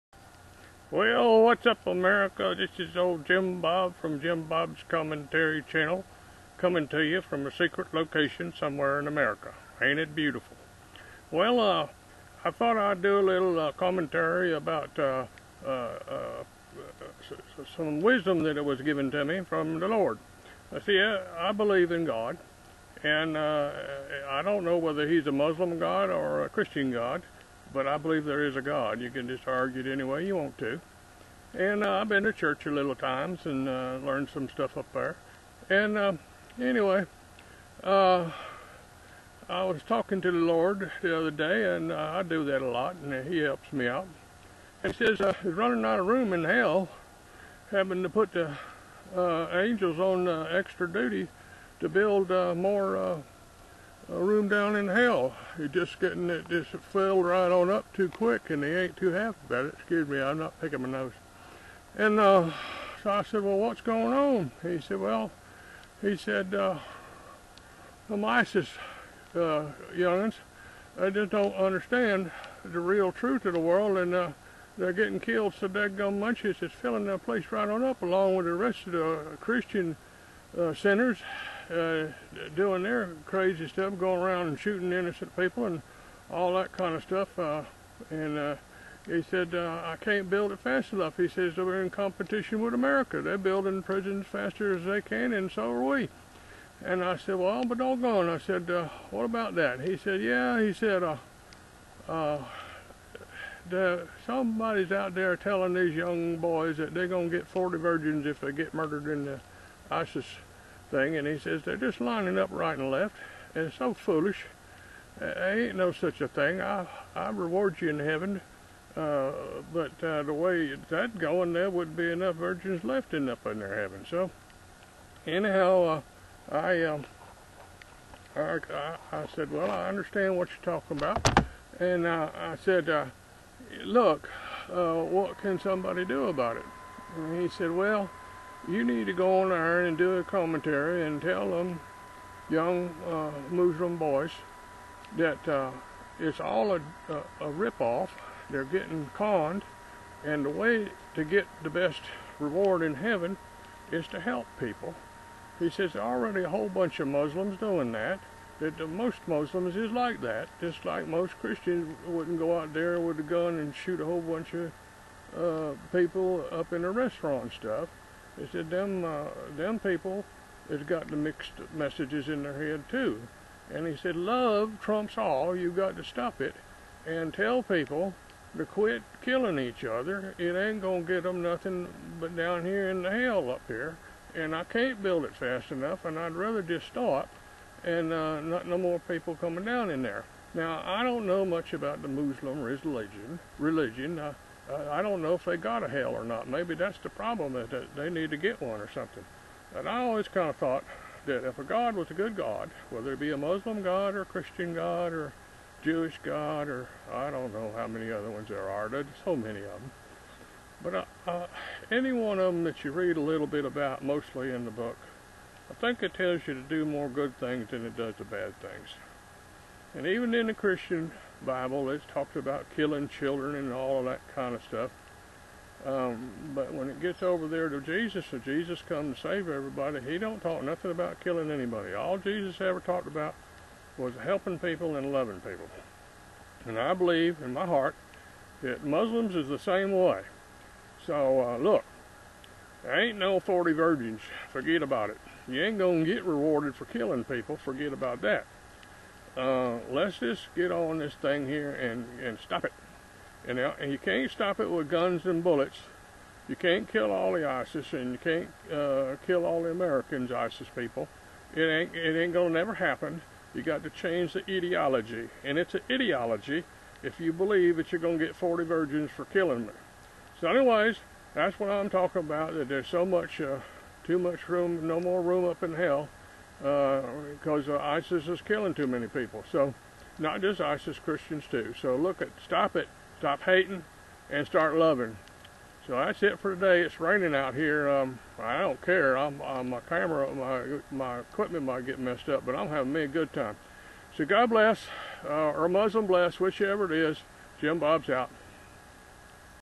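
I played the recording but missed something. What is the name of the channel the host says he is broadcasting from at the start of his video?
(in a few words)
Jim Bob's Commentary Channel.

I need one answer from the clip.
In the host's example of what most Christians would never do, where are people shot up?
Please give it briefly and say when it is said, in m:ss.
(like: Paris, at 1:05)
A restaurant, at 2:46.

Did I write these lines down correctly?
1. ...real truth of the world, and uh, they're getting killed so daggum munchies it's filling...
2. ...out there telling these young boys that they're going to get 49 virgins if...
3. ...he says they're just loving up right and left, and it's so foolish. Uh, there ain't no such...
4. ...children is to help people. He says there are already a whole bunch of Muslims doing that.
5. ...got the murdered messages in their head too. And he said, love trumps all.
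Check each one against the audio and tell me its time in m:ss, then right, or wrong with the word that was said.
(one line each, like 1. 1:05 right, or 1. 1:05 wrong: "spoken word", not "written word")
1. 1:12 right
2. 1:44 wrong: "40", not "49"
3. 1:51 wrong: "lining", not "loving"
4. 2:32 wrong: "heaven", not "children"
5. 2:50 wrong: "mixed", not "murdered".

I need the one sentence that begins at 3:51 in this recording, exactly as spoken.
All Jesus ever talked about was helping people and loving people.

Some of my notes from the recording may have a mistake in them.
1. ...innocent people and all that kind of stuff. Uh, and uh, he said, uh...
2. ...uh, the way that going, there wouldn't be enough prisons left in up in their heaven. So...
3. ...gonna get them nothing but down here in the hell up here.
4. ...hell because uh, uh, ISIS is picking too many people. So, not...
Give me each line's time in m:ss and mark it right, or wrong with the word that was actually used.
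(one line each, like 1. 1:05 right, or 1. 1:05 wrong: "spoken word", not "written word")
1. 1:24 right
2. 2:00 wrong: "virgins", not "prisons"
3. 3:00 right
4. 4:35 wrong: "killing", not "picking".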